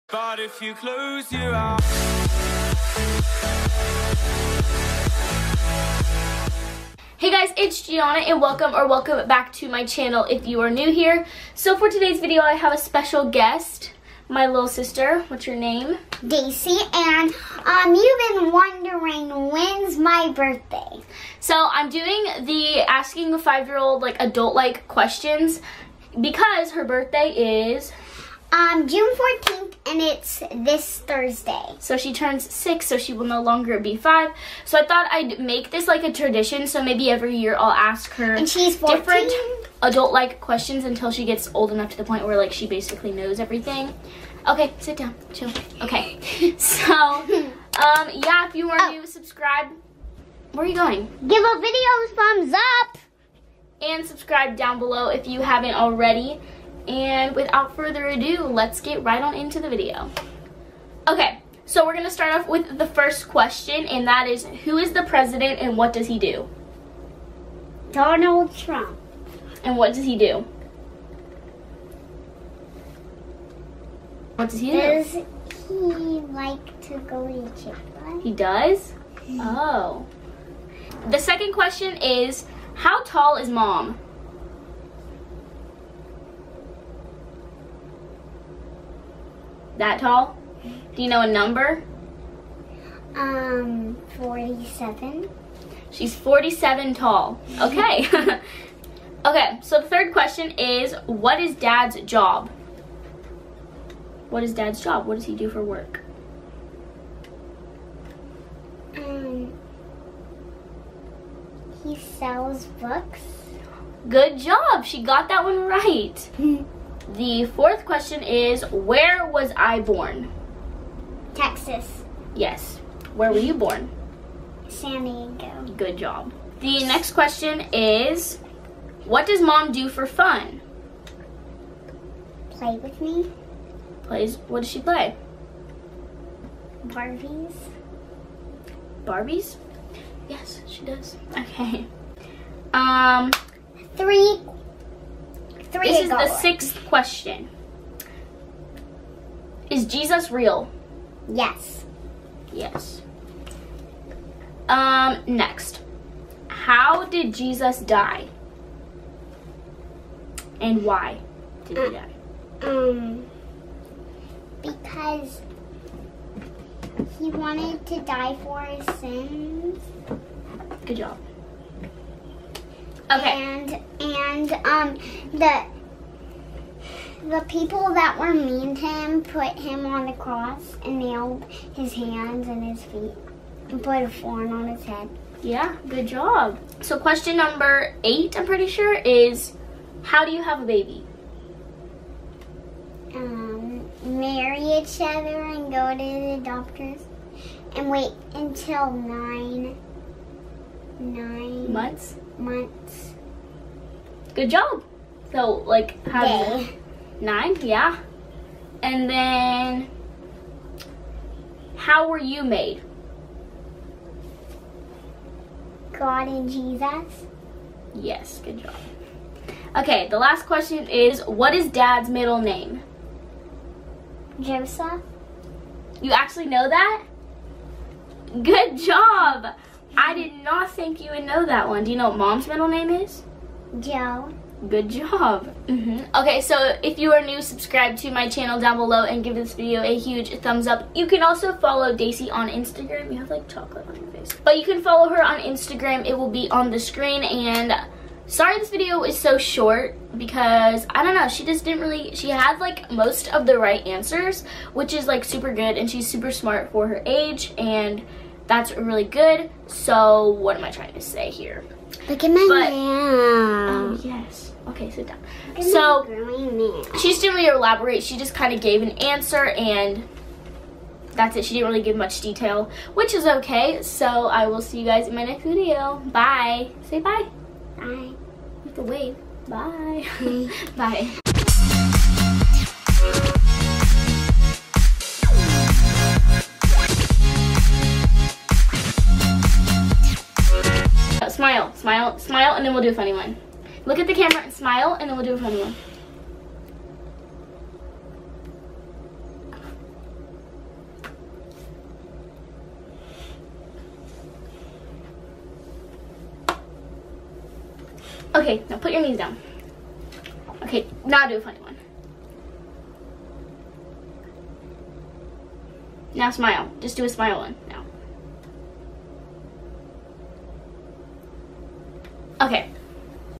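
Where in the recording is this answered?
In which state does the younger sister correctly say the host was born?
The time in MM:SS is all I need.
02:01.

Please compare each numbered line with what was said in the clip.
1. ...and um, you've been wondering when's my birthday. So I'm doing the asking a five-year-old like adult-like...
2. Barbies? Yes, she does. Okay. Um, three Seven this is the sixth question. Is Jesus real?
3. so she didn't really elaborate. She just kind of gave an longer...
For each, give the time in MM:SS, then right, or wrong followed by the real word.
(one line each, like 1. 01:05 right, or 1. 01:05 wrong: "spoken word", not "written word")
1. 00:16 right
2. 02:19 wrong: "Three", not "Seven"
3. 04:25 wrong: "answer", not "longer".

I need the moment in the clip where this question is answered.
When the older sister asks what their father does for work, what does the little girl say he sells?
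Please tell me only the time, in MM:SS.
01:51.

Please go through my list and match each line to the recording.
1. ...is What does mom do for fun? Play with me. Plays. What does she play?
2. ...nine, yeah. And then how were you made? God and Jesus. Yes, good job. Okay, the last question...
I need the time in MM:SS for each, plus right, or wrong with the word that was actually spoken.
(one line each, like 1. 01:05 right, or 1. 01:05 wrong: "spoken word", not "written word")
1. 02:07 right
2. 03:27 right.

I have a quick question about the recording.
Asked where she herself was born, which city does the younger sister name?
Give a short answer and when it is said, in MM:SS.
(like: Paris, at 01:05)
San Diego, at 02:04.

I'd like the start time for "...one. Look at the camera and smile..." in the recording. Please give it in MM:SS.
04:53.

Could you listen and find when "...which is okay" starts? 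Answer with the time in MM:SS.
04:32.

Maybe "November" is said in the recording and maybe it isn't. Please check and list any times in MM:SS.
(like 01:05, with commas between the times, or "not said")
not said.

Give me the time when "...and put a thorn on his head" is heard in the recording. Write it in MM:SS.
03:03.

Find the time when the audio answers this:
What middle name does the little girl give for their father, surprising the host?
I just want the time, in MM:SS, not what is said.
03:44.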